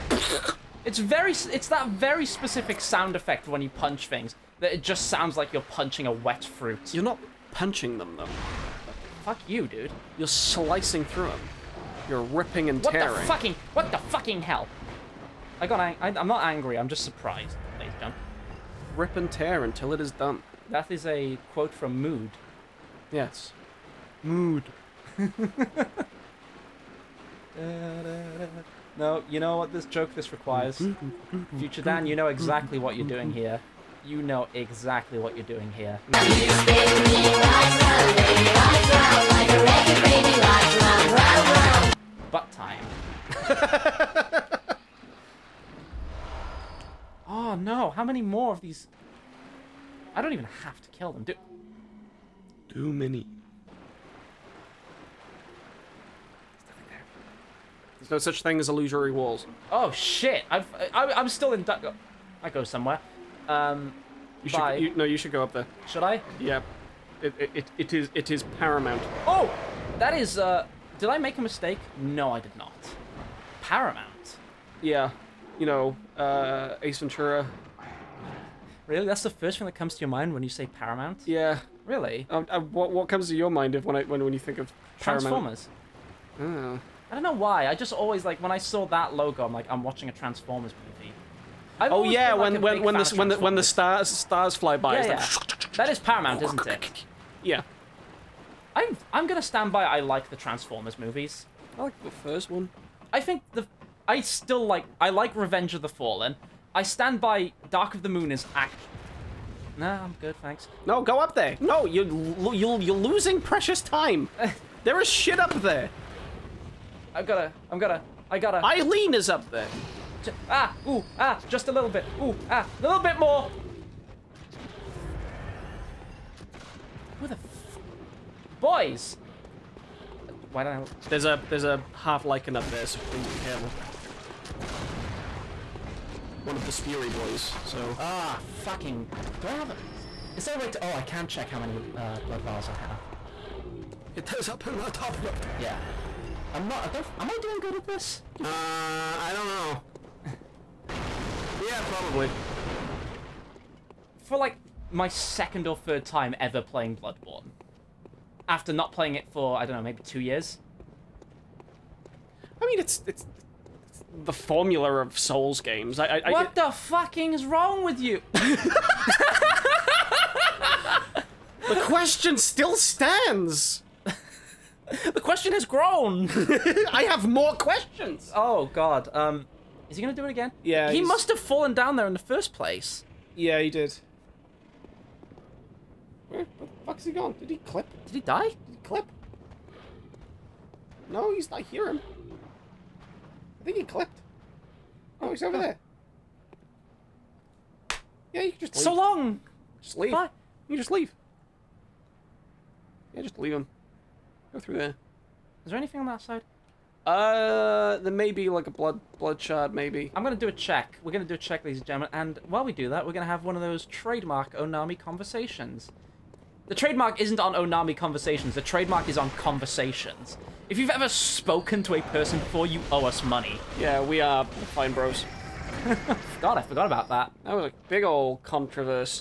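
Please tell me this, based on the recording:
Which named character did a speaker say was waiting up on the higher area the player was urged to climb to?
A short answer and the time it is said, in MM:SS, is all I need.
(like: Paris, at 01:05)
Eileen, at 01:58.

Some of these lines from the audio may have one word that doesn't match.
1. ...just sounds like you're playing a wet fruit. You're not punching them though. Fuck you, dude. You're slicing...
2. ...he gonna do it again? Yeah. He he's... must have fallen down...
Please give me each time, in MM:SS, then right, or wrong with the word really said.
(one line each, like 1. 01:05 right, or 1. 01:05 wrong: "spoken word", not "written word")
1. 00:04 wrong: "punching", not "playing"
2. 02:59 right.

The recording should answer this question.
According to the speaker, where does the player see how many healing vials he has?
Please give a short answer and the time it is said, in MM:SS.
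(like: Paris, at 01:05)
top left, at 02:24.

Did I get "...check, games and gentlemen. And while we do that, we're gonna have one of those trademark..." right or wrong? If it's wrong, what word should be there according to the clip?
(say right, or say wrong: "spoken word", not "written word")
wrong: "ladies", not "games".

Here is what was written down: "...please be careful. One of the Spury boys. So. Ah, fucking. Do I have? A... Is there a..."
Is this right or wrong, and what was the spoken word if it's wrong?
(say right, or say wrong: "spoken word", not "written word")
right.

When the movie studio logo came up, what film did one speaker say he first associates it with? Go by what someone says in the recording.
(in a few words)
Ace Ventura.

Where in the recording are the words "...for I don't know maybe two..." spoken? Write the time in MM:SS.
02:39.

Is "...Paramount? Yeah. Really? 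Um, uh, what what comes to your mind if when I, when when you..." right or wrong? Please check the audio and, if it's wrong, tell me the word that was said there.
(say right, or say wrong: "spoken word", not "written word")
right.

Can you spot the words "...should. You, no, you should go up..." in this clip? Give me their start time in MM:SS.
01:04.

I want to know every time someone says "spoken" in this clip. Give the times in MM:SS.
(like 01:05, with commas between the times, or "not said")
03:41.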